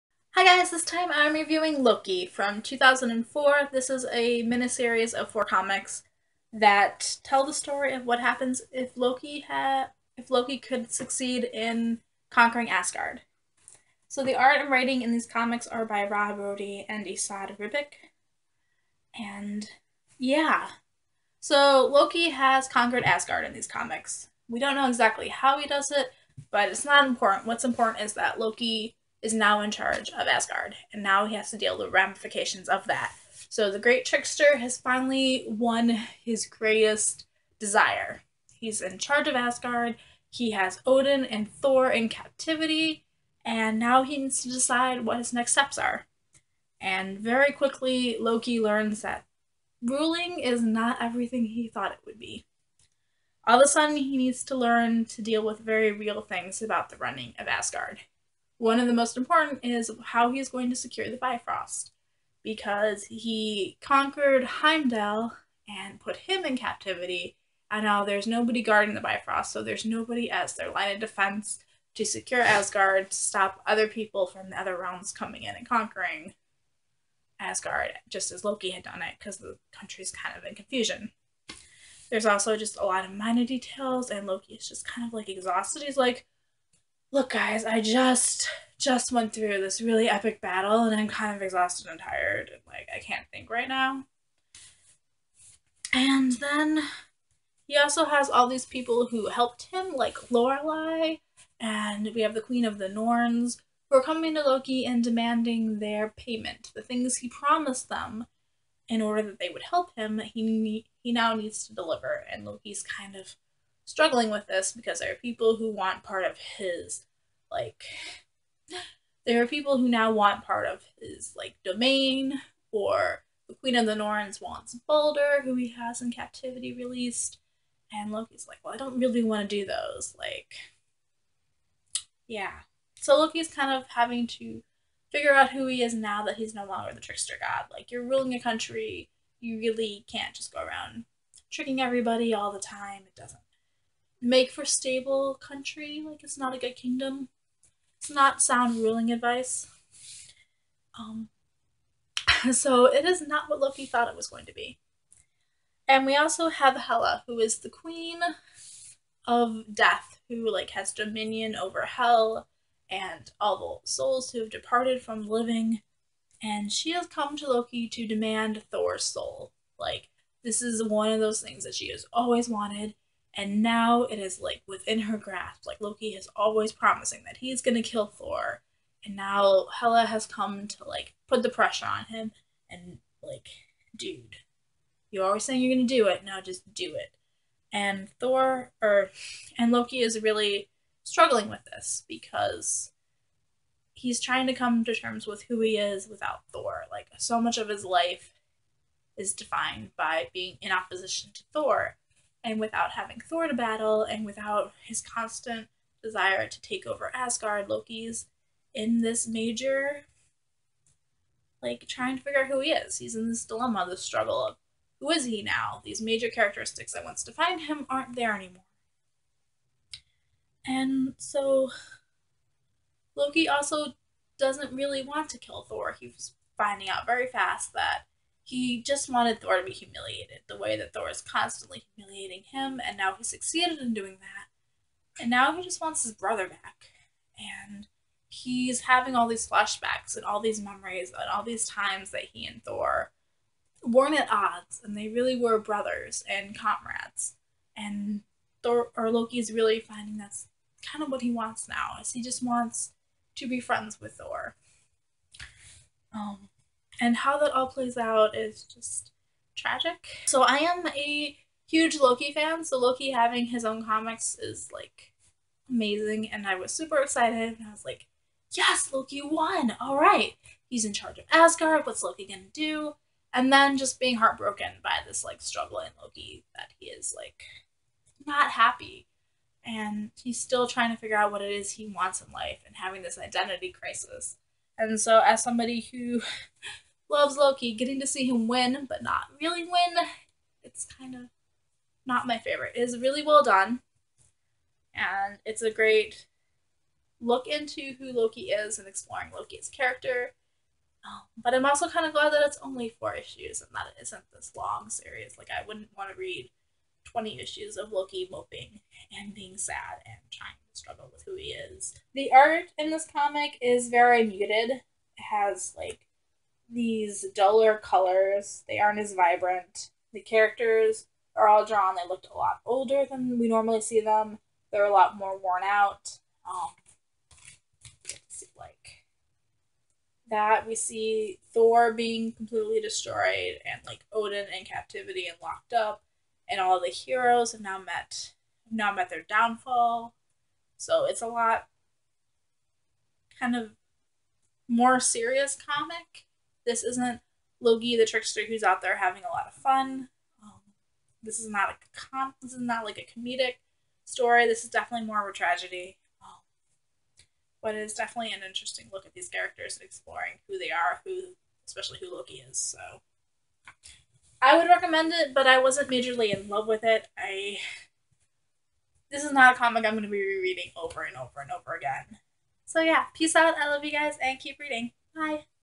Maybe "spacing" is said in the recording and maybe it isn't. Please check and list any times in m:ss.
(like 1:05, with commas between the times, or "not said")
not said.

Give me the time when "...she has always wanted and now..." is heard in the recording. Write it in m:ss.
2:51.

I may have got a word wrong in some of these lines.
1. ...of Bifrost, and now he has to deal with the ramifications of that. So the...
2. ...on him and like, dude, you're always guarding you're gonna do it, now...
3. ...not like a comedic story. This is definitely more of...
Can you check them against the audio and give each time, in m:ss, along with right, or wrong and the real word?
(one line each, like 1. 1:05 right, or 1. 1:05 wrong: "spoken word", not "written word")
1. 0:30 wrong: "Asgard", not "Bifrost"
2. 3:01 wrong: "saying", not "guarding"
3. 5:52 right.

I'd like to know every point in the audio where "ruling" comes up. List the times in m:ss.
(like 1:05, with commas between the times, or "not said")
0:49, 2:18, 2:28.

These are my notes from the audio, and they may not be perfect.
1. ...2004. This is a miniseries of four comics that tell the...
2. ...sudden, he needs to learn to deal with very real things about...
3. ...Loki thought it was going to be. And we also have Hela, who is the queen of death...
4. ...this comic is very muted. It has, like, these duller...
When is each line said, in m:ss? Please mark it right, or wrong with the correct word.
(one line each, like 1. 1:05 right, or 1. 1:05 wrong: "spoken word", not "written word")
1. 0:02 right
2. 0:53 right
3. 2:33 right
4. 5:12 right.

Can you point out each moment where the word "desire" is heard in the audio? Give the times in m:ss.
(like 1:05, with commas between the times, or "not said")
0:37, 3:26.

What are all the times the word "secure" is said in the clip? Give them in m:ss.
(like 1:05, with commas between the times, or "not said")
1:00, 1:12.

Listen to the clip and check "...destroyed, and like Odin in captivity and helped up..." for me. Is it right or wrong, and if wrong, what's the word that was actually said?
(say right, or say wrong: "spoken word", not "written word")
wrong: "locked", not "helped".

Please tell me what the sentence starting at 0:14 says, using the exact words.
So the art and writing in these comics are by Rob Rodi and Esad Ribic.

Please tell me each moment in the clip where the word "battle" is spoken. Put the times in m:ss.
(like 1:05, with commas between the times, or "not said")
1:30, 3:23.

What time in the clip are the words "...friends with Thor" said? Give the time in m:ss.
4:13.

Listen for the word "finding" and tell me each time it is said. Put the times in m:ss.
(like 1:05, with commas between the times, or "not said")
3:46, 4:09.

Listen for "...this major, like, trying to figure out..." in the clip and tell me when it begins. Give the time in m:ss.
3:29.